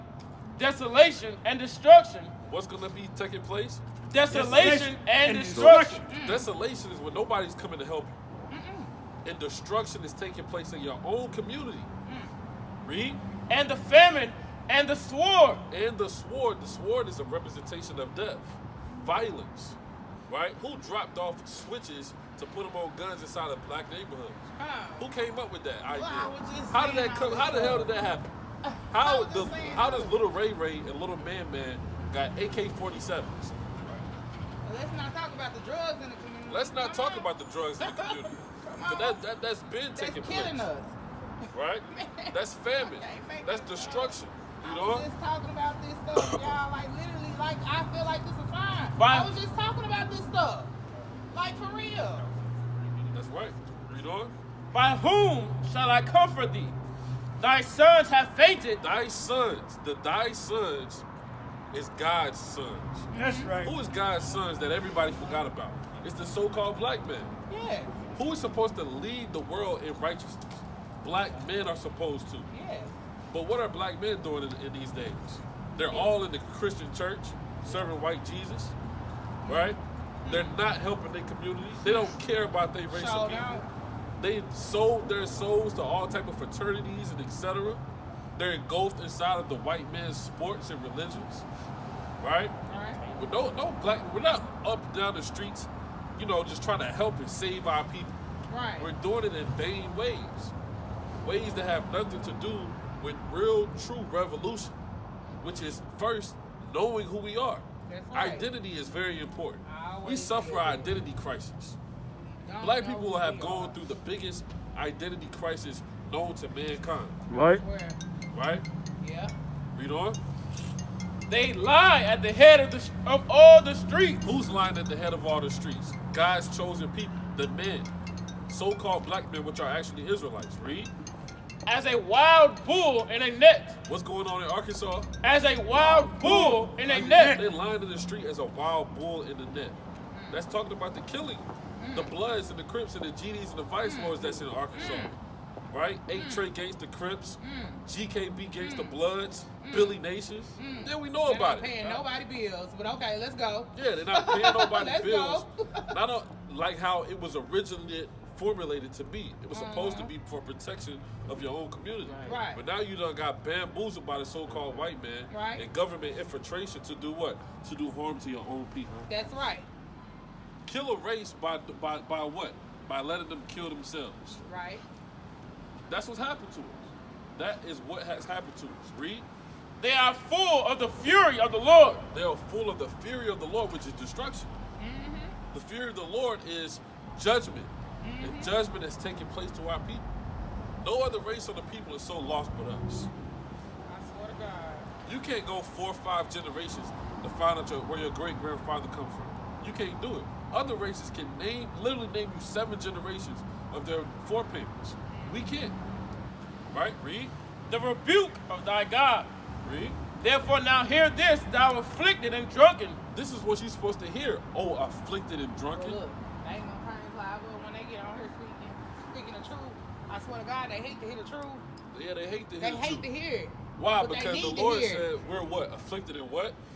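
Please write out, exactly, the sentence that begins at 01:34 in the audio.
We're not up and down the streets, you know, just trying to help and save our people.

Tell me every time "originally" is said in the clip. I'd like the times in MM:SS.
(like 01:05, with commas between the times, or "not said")
02:37.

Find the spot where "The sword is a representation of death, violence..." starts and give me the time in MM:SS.
00:16.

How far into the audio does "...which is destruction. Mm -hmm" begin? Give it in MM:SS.
03:03.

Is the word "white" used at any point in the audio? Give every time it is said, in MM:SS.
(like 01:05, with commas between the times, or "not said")
01:17, 01:29, 02:44.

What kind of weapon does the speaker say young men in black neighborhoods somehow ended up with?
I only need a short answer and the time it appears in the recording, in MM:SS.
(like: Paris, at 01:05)
AK-47s, at 00:32.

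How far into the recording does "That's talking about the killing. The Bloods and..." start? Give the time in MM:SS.
02:20.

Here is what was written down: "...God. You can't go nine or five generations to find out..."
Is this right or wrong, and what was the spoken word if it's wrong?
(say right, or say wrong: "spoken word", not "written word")
wrong: "four", not "nine".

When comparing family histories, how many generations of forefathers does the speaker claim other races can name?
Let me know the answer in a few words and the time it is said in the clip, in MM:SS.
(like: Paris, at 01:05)
7, at 03:22.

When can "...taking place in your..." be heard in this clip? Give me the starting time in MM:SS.
00:10.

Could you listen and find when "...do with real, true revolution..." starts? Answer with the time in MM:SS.
01:42.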